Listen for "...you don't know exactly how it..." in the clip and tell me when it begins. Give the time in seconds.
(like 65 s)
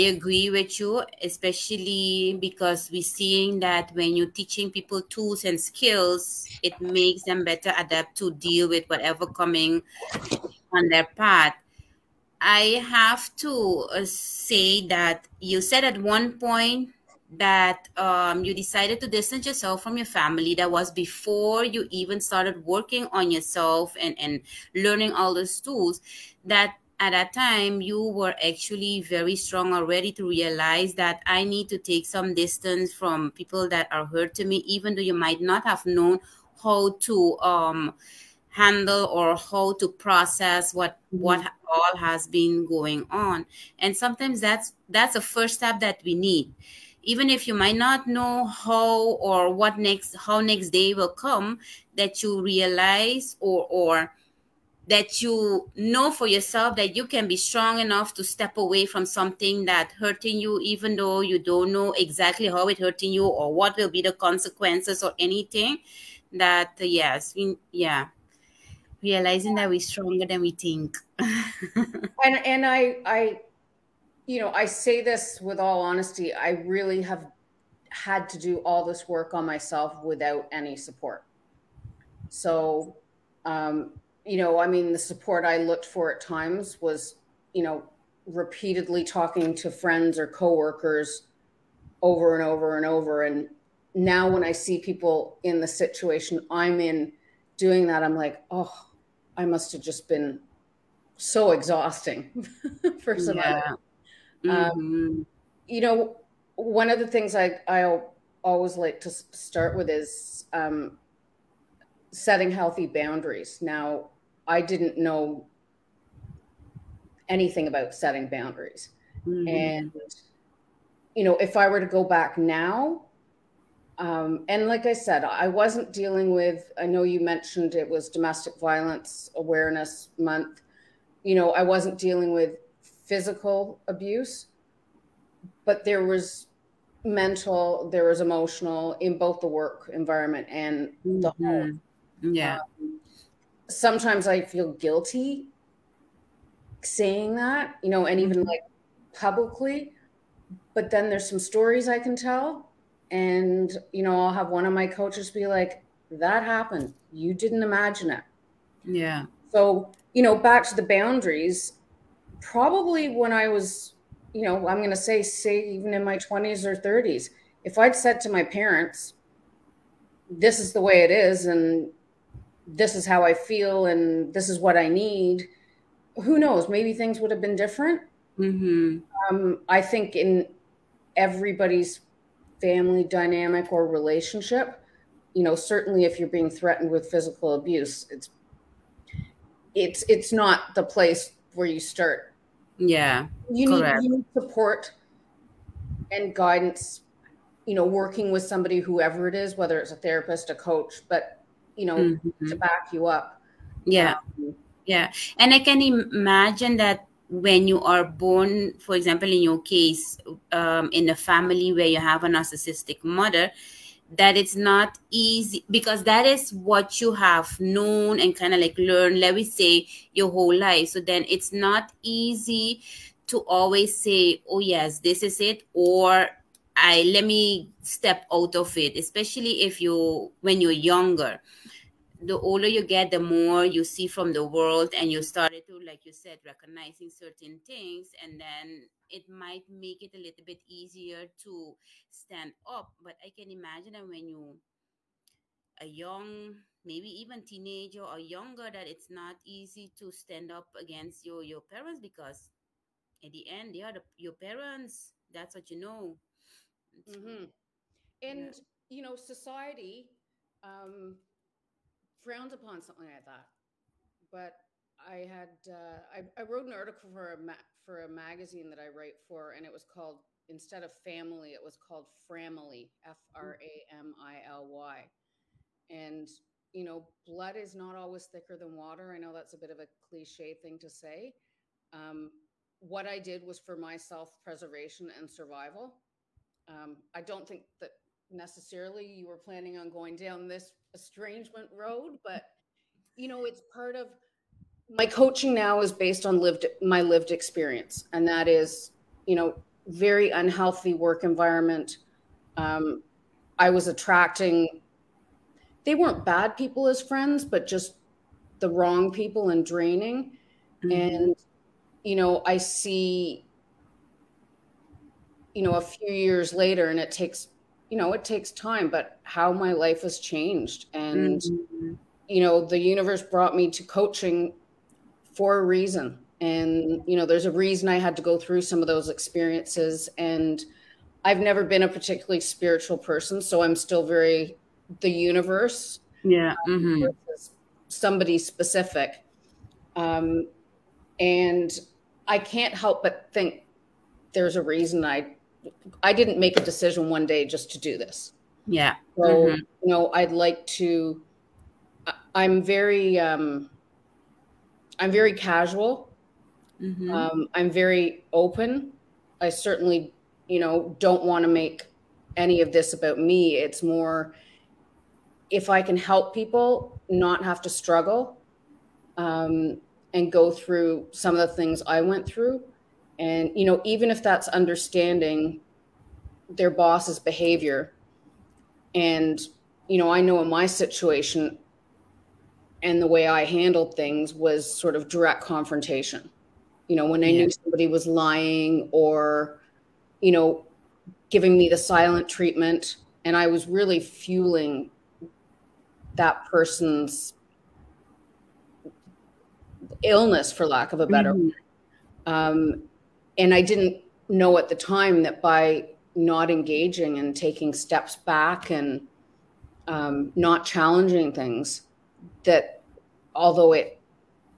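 61 s.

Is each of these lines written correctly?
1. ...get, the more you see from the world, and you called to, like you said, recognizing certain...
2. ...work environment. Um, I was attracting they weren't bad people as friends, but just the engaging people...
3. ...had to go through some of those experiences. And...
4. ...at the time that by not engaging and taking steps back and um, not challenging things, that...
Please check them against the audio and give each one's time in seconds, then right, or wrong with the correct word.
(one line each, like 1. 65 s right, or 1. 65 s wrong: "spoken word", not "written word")
1. 232 s wrong: "started", not "called"
2. 300 s wrong: "wrong", not "engaging"
3. 327 s right
4. 404 s right.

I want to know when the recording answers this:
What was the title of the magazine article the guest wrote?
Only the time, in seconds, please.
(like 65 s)
272 s.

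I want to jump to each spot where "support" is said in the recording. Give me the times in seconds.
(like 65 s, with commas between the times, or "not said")
80 s, 84 s, 194 s.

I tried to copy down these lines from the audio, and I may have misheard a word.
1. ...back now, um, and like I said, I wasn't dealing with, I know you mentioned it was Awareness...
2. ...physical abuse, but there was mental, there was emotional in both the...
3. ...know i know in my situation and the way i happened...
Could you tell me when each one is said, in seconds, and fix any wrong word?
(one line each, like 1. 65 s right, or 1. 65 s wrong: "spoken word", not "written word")
1. 122 s wrong: "Domestic", not "Awareness"
2. 133 s right
3. 379 s wrong: "handled", not "happened".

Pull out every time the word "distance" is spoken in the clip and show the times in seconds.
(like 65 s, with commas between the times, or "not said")
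19 s, 32 s.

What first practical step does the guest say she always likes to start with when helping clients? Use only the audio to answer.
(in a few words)
setting healthy boundaries.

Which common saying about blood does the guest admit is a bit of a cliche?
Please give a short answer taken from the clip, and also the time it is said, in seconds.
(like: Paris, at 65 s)
blood is not always thicker than water, at 277 s.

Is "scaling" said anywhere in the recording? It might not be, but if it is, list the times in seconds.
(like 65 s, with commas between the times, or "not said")
not said.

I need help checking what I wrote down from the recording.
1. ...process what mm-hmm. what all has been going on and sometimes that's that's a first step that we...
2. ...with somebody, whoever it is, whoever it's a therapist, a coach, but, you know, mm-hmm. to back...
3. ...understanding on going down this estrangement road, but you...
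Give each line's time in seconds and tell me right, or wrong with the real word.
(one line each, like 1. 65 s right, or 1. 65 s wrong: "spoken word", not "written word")
1. 39 s right
2. 198 s wrong: "whether", not "whoever"
3. 289 s wrong: "planning", not "understanding".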